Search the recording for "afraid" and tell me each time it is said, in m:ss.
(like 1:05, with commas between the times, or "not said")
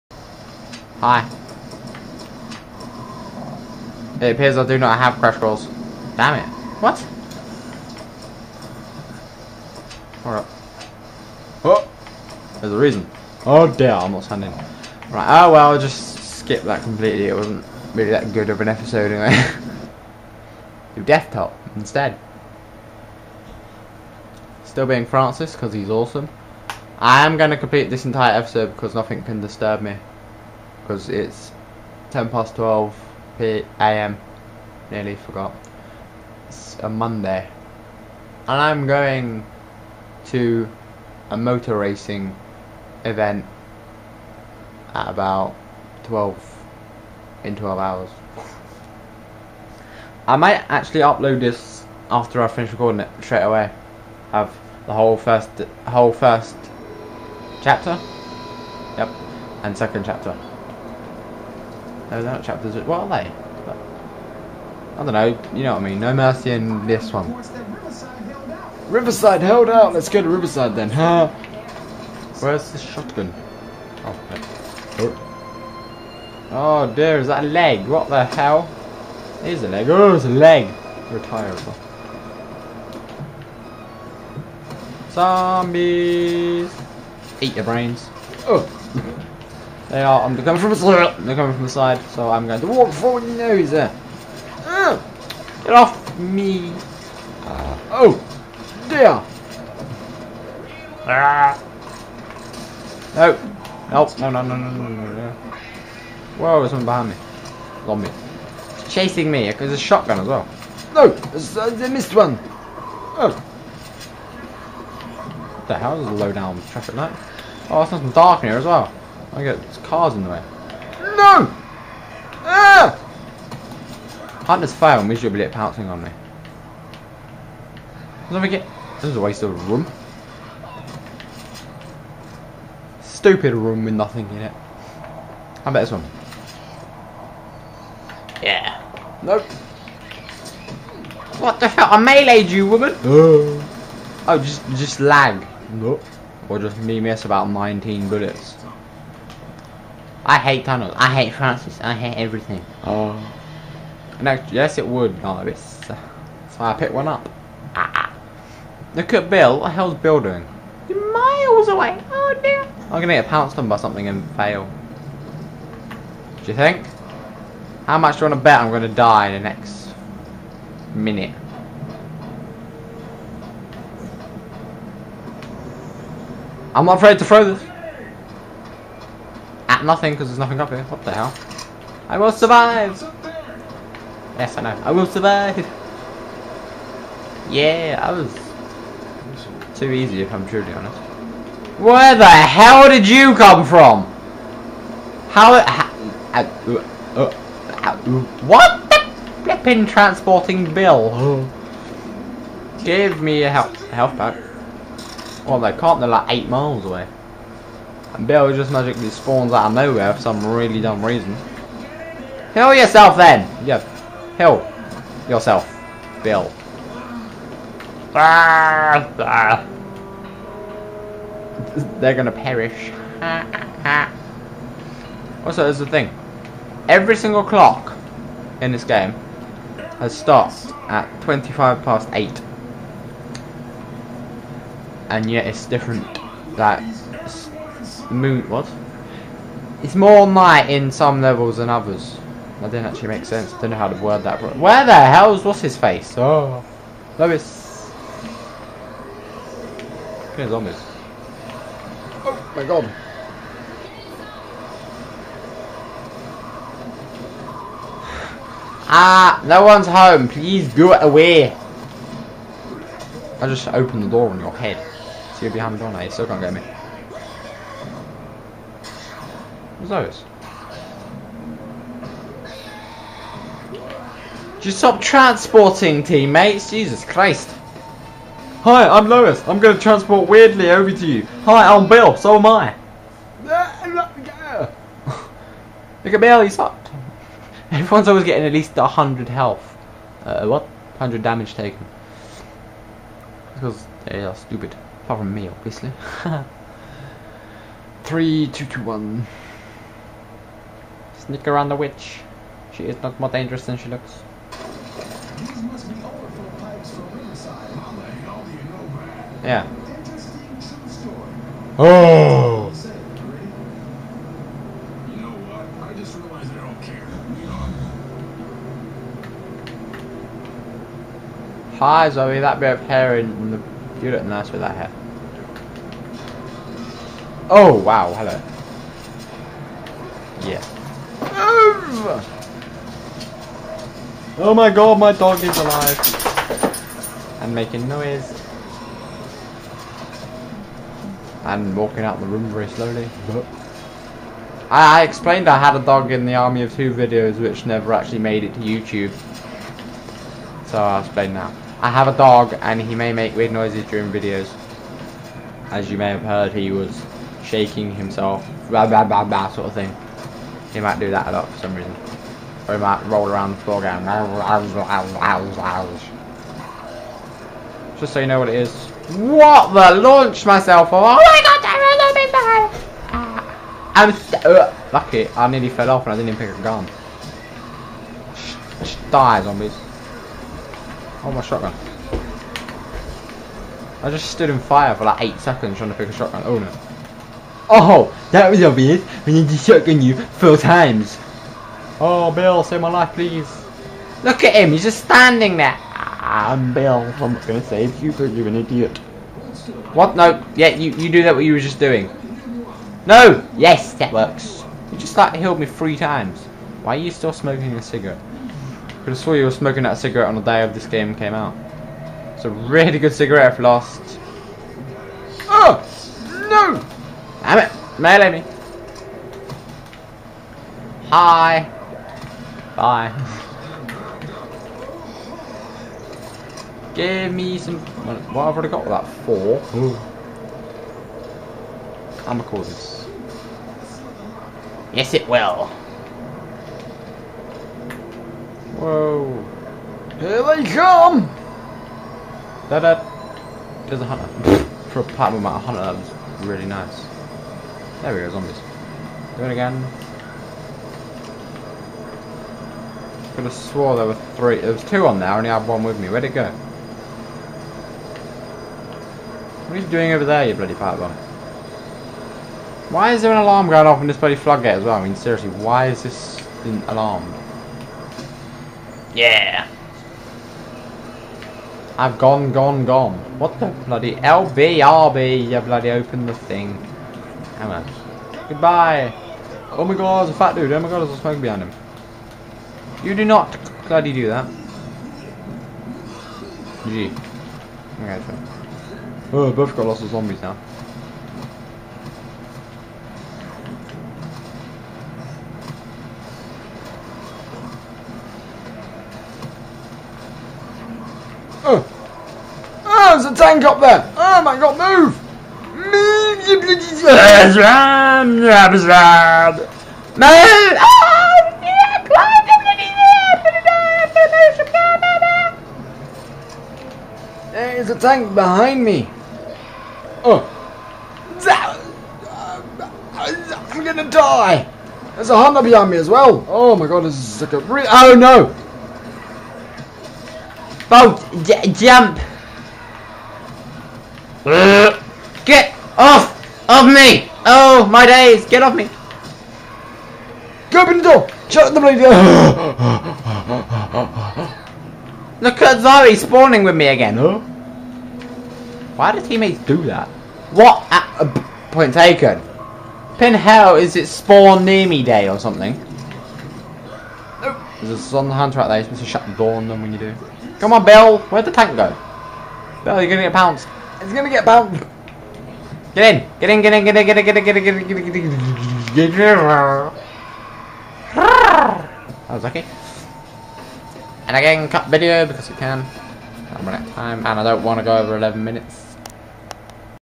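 2:56.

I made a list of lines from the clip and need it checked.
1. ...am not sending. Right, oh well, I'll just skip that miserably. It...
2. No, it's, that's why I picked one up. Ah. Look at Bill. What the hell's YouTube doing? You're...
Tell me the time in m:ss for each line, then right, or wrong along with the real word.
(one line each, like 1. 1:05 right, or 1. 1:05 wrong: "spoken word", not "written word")
1. 0:14 wrong: "completely", not "miserably"
2. 2:35 wrong: "Bill", not "YouTube".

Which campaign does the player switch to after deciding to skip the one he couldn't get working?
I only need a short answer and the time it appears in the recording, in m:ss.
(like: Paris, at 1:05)
Death Toll, at 0:21.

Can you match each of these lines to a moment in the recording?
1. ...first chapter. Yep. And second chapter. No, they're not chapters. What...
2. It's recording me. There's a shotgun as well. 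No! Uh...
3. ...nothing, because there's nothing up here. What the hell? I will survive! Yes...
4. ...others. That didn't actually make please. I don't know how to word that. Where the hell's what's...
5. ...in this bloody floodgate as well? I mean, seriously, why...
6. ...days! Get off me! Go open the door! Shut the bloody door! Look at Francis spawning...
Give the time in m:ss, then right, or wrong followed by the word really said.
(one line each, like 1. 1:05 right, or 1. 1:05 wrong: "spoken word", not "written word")
1. 0:56 right
2. 1:48 wrong: "chasing", not "recording"
3. 2:59 right
4. 4:01 wrong: "sense", not "please"
5. 7:44 right
6. 8:58 wrong: "Zari", not "Francis".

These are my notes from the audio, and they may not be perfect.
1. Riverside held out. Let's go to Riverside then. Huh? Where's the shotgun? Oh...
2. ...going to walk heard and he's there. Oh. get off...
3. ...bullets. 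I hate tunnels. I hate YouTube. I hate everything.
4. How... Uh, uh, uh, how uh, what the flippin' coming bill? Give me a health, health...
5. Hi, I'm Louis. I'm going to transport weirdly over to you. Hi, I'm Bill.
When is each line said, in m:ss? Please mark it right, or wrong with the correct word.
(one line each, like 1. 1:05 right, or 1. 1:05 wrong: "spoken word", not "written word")
1. 1:08 right
2. 1:32 wrong: "forward", not "heard"
3. 2:28 wrong: "Francis", not "YouTube"
4. 3:15 wrong: "transporting", not "coming"
5. 4:38 right.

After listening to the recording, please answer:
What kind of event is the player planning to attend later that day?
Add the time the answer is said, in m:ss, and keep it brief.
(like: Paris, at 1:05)
motor racing event, at 0:41.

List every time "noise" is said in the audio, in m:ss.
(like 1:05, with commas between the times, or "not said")
5:37, 5:53.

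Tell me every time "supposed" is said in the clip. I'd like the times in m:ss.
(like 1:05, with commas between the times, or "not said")
9:18.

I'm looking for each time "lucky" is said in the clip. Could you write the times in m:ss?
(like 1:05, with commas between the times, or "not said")
6:14, 9:32.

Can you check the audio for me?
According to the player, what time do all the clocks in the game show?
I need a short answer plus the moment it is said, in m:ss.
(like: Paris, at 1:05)
25 past 8, at 3:51.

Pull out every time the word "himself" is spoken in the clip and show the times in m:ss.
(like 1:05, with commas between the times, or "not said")
5:57.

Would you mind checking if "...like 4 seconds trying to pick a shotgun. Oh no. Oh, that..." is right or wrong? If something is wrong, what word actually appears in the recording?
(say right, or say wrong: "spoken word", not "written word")
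wrong: "8", not "4".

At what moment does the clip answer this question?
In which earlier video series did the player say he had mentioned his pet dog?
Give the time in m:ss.
5:46.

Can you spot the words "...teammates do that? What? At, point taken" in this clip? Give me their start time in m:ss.
9:09.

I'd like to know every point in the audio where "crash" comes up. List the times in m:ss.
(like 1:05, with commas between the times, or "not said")
0:05.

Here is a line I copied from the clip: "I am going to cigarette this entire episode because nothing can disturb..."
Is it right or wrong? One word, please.
wrong.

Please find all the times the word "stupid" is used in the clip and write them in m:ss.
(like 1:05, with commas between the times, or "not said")
2:13, 4:54.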